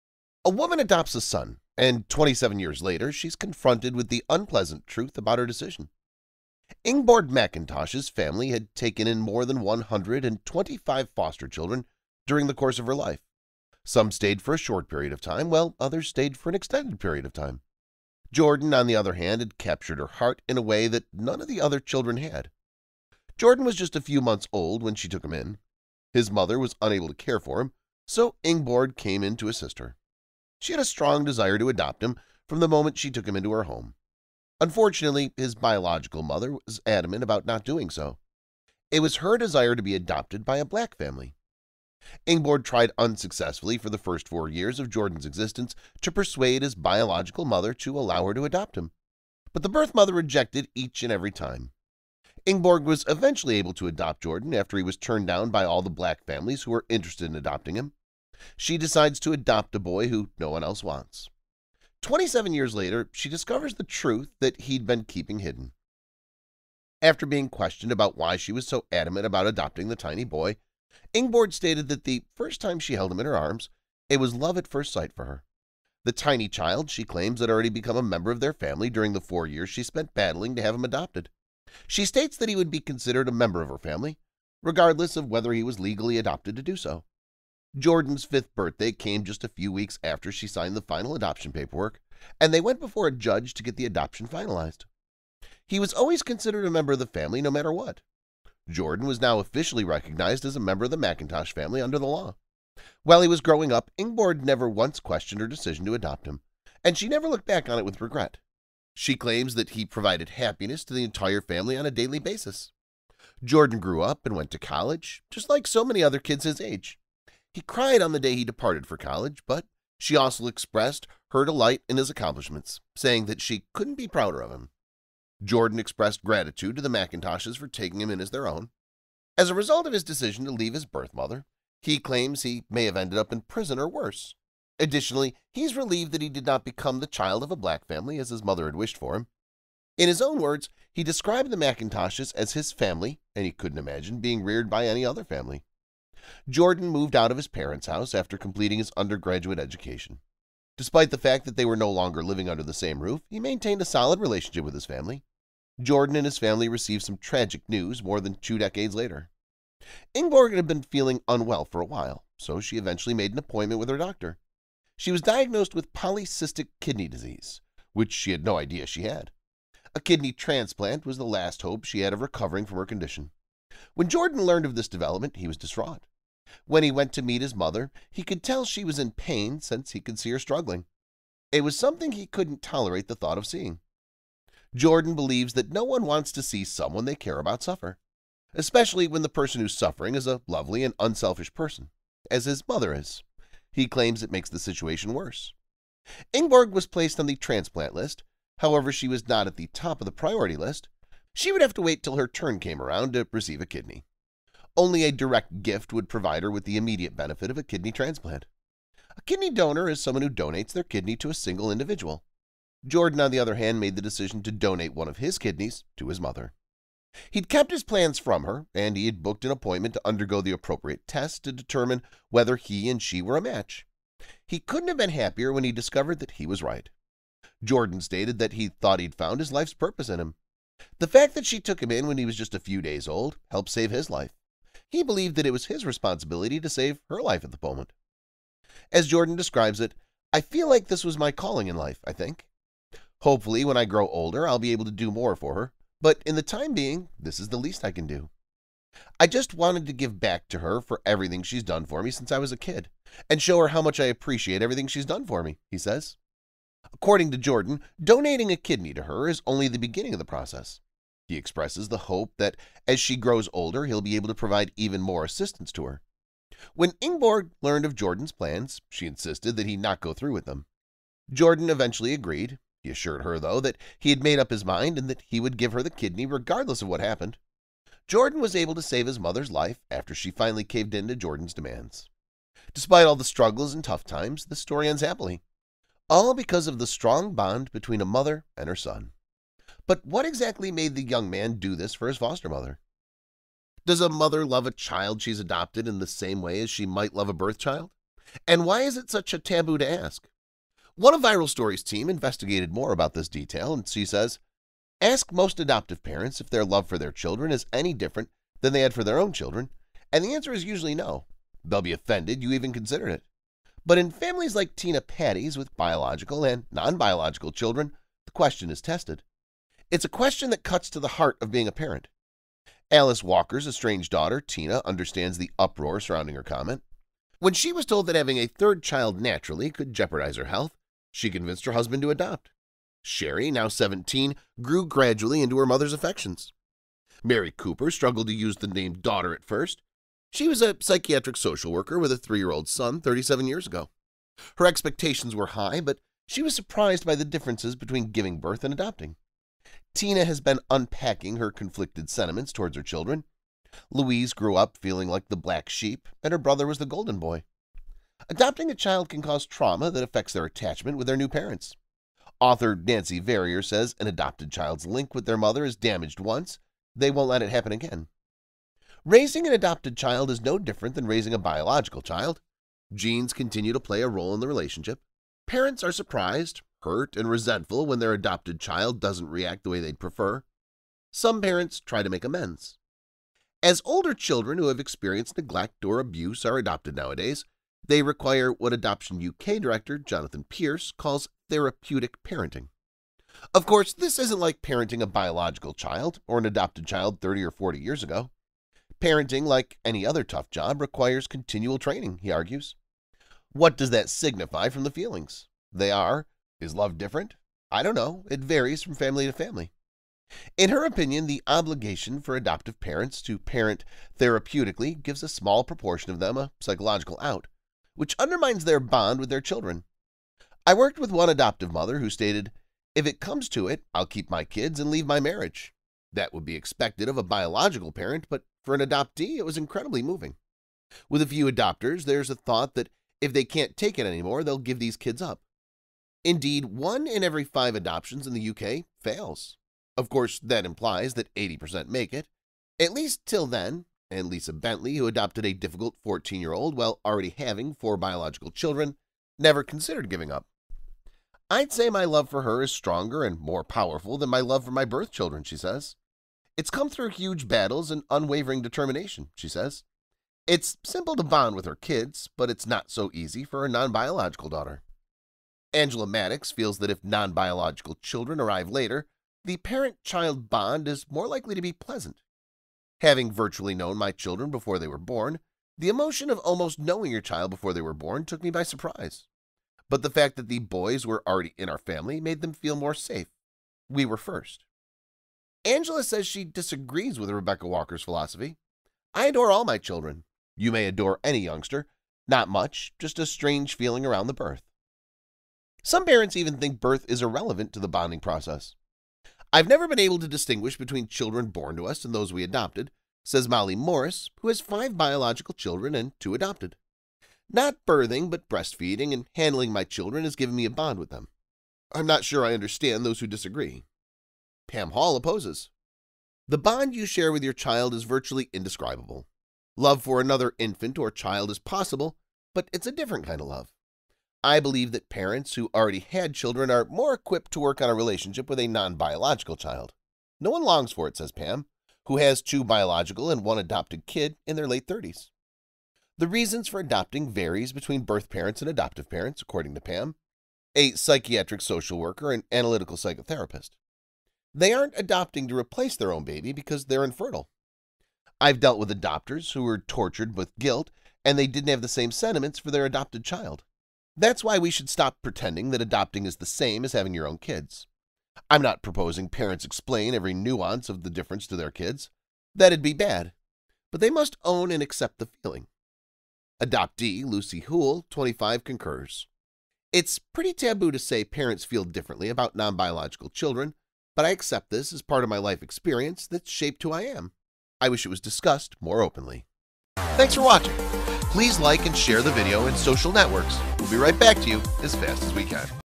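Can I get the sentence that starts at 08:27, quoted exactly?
Not birthing, but breastfeeding and handling my children has given me a bond with them.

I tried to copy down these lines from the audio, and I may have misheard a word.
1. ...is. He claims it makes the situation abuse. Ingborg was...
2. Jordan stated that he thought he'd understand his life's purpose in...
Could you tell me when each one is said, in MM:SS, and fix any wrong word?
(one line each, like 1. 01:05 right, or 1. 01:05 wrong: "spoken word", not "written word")
1. 03:12 wrong: "worse", not "abuse"
2. 03:47 wrong: "found", not "understand".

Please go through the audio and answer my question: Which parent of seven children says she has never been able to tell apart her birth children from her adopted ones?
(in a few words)
Molly Morris.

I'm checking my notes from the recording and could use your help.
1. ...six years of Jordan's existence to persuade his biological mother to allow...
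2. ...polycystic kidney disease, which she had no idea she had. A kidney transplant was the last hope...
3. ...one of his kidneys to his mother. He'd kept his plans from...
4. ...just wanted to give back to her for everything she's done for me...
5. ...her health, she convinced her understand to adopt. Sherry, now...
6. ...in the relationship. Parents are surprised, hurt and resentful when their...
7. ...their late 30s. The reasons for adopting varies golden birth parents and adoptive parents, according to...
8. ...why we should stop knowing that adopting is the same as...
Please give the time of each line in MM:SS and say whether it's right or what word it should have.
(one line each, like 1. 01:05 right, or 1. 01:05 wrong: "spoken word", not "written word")
1. 00:44 wrong: "four", not "six"
2. 02:45 right
3. 03:34 right
4. 04:09 right
5. 05:30 wrong: "husband", not "understand"
6. 06:14 right
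7. 08:54 wrong: "between", not "golden"
8. 09:14 wrong: "pretending", not "knowing".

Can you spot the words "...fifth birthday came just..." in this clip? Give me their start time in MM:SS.
01:28.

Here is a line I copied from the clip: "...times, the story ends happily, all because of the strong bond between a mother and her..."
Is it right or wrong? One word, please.
right.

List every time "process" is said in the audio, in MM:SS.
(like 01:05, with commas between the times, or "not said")
04:20, 08:18.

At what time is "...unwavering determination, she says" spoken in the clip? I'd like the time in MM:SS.
07:38.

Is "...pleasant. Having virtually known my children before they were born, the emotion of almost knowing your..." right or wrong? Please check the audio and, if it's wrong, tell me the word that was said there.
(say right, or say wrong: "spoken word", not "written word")
right.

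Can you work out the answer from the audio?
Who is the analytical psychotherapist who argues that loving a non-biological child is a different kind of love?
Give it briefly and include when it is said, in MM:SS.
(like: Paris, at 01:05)
Pam Hall, at 08:34.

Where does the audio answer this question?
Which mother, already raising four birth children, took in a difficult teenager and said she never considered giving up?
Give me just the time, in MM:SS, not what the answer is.
07:24.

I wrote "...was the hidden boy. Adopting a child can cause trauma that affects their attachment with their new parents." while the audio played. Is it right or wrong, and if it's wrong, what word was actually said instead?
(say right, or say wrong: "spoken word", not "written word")
wrong: "golden", not "hidden".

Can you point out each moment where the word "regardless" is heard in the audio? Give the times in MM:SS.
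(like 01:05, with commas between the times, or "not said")
01:24, 04:36.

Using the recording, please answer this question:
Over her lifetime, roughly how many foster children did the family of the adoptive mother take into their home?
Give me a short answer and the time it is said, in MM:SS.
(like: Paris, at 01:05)
More than 125, at 00:09.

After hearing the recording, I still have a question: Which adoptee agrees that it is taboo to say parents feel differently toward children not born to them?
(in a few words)
Lucy Houle.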